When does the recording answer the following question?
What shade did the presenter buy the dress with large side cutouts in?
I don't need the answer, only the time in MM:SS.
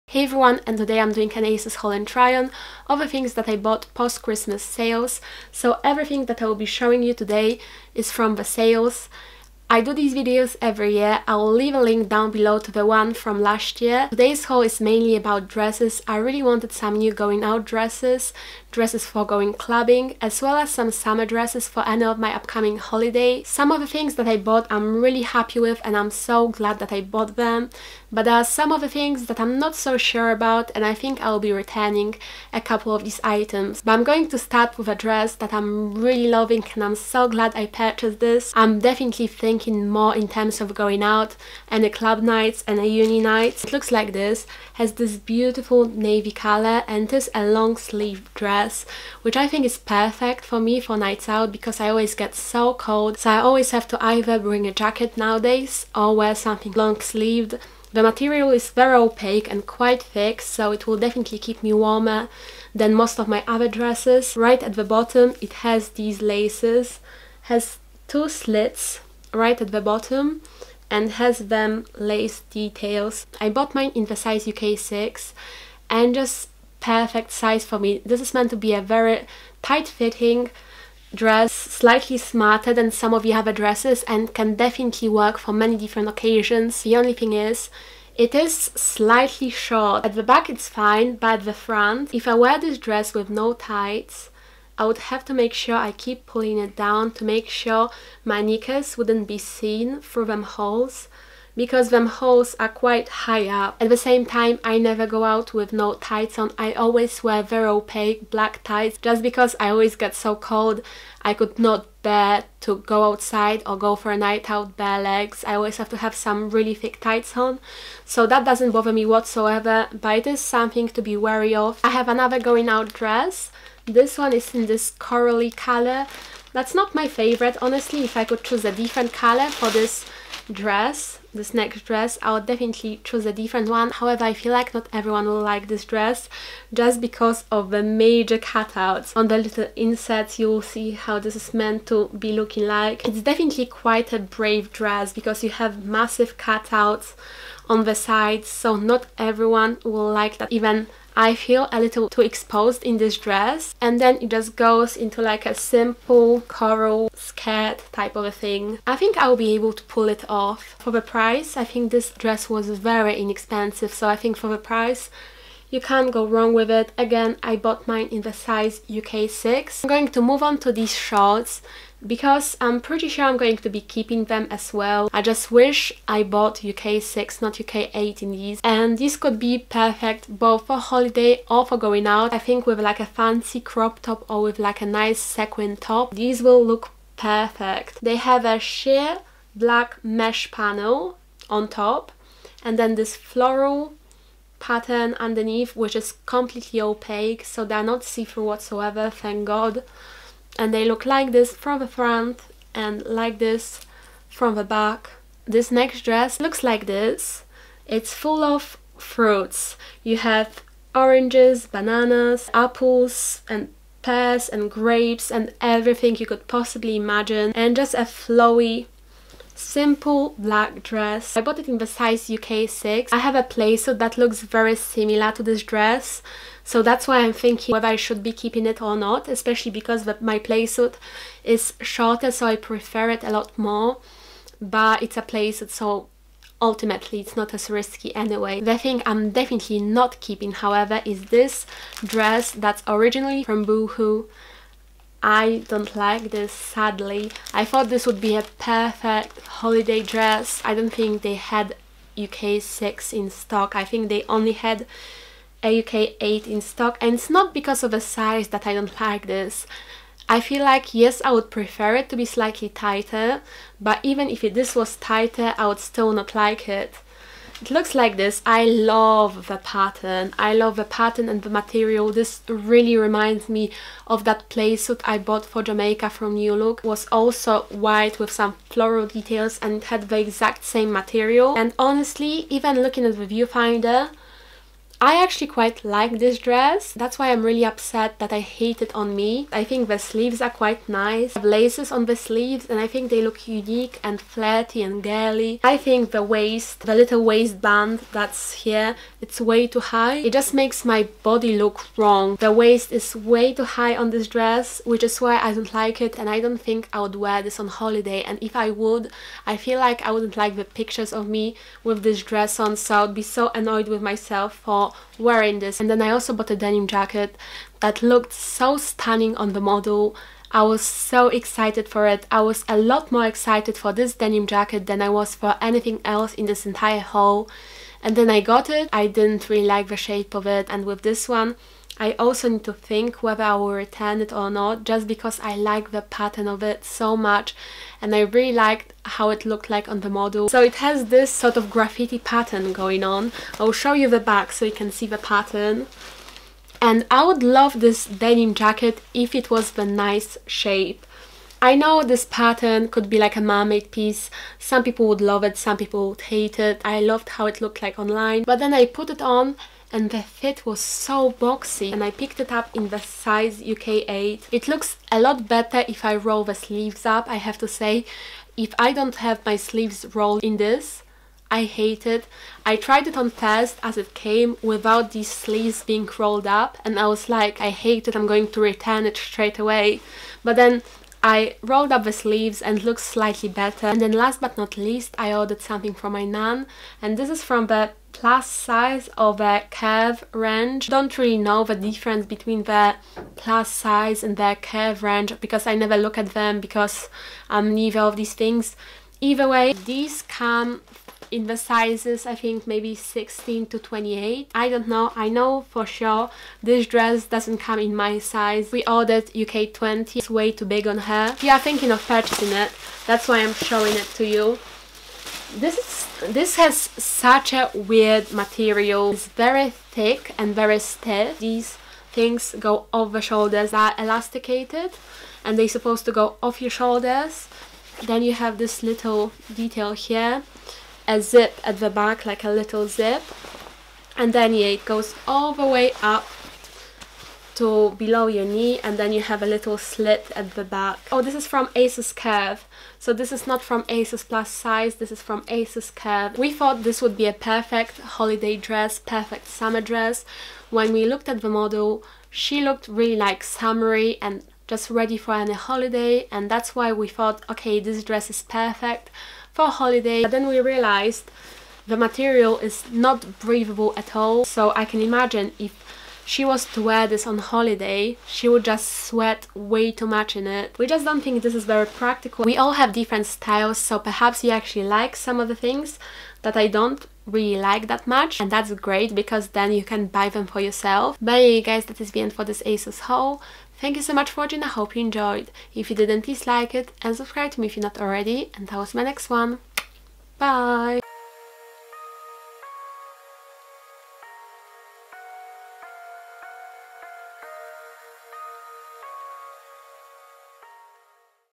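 02:04.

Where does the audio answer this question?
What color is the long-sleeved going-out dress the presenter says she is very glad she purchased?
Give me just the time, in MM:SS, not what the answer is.
00:45.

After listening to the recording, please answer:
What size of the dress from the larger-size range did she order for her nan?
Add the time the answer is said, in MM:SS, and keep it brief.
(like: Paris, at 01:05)
UK 20, at 06:49.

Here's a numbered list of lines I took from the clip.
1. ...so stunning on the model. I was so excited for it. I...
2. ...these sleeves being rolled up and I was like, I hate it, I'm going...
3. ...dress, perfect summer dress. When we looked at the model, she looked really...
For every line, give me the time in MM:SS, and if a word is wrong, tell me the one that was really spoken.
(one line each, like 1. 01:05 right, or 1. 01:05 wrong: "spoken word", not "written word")
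1. 05:18 right
2. 06:15 right
3. 07:28 right.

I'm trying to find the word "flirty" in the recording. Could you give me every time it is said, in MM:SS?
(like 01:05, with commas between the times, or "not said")
04:54.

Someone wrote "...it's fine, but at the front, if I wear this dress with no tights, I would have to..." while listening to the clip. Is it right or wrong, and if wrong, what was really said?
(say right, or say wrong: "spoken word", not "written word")
right.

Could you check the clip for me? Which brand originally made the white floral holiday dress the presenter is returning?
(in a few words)
Boohoo.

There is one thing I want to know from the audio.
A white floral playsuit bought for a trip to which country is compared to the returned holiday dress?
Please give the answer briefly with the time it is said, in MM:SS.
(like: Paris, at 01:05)
Jamaica, at 04:35.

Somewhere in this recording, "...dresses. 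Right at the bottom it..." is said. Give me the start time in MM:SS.
01:03.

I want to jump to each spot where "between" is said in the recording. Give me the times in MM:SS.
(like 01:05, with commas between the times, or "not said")
06:32.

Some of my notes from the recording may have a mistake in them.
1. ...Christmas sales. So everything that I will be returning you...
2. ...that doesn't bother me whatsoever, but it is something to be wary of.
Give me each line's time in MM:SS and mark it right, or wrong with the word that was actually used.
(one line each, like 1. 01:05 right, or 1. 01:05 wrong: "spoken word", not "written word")
1. 00:04 wrong: "showing", not "returning"
2. 01:58 right.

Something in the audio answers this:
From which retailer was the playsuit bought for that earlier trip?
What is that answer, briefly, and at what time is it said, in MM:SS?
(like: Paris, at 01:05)
New Look, at 04:36.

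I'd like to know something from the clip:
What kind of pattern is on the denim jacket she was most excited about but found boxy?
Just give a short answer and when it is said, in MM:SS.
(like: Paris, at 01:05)
Graffiti, at 05:41.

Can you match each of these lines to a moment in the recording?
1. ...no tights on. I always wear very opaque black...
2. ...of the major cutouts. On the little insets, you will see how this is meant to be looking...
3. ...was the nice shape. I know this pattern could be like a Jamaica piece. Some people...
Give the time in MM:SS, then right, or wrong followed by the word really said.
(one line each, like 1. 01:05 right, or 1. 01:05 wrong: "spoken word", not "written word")
1. 01:45 right
2. 02:17 right
3. 05:49 wrong: "Marmite", not "Jamaica".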